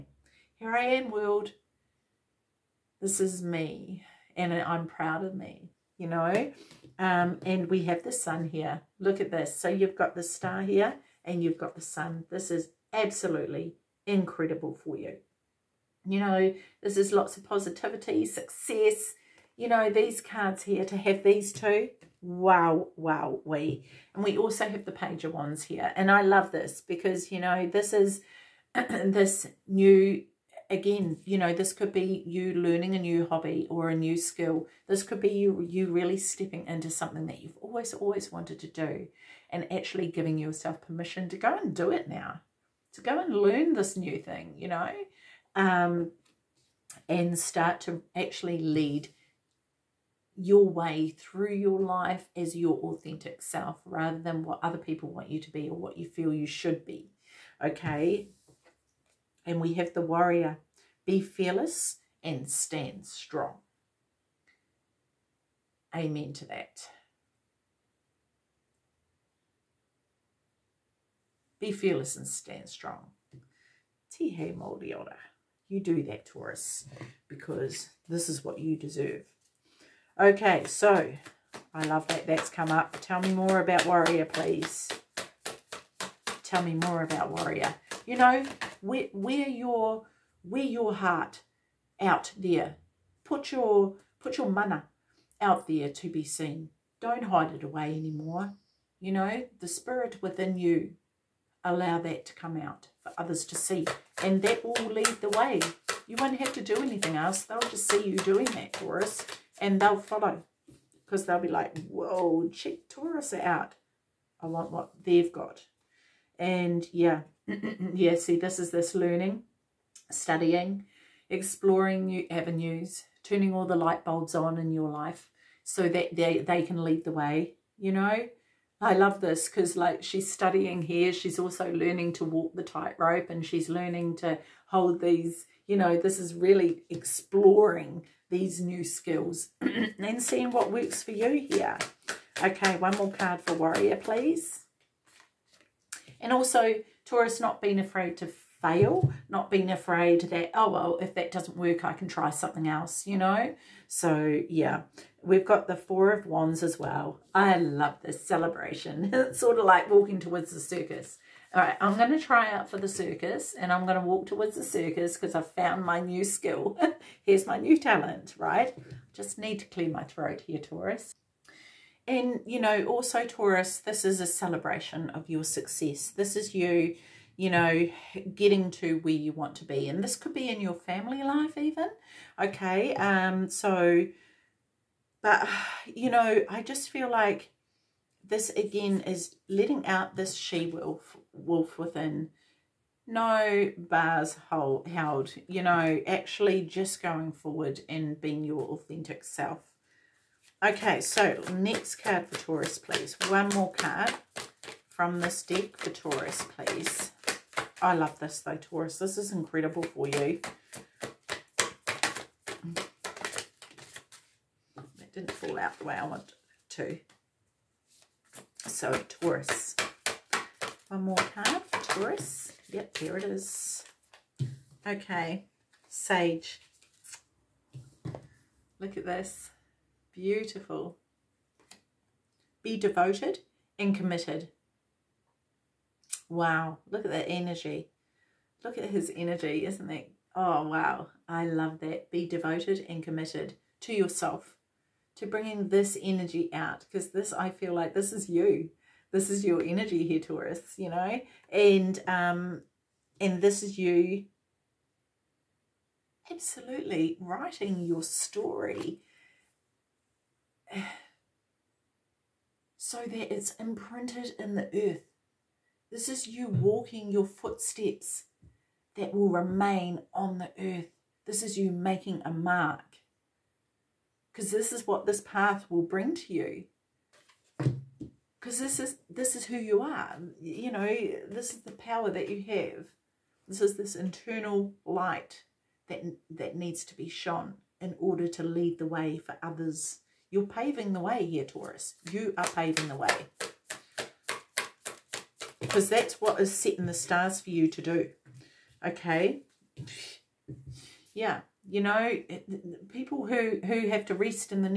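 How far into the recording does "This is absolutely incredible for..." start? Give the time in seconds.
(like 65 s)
12 s.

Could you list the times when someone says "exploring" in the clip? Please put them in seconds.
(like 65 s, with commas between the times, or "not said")
121 s, 136 s.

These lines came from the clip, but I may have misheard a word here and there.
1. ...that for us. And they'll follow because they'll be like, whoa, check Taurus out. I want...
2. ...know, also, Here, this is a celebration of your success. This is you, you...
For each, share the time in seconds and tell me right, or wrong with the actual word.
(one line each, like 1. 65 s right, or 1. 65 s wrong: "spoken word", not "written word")
1. 108 s right
2. 172 s wrong: "Taurus", not "Here".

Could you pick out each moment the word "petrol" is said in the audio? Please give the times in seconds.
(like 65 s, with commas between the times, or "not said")
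not said.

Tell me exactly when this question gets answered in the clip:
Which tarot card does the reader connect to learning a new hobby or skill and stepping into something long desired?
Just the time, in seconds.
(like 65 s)
24 s.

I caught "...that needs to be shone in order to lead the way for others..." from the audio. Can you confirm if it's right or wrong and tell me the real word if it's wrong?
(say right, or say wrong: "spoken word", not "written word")
right.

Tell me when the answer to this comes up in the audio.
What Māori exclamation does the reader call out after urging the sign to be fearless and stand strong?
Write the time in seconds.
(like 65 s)
74 s.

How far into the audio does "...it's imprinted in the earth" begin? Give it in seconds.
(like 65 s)
263 s.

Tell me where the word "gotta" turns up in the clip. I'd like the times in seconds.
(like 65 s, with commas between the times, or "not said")
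not said.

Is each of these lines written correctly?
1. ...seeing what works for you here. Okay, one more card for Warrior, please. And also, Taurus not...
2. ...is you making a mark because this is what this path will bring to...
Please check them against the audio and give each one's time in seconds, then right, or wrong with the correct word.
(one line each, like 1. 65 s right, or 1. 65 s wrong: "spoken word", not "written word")
1. 140 s right
2. 271 s right.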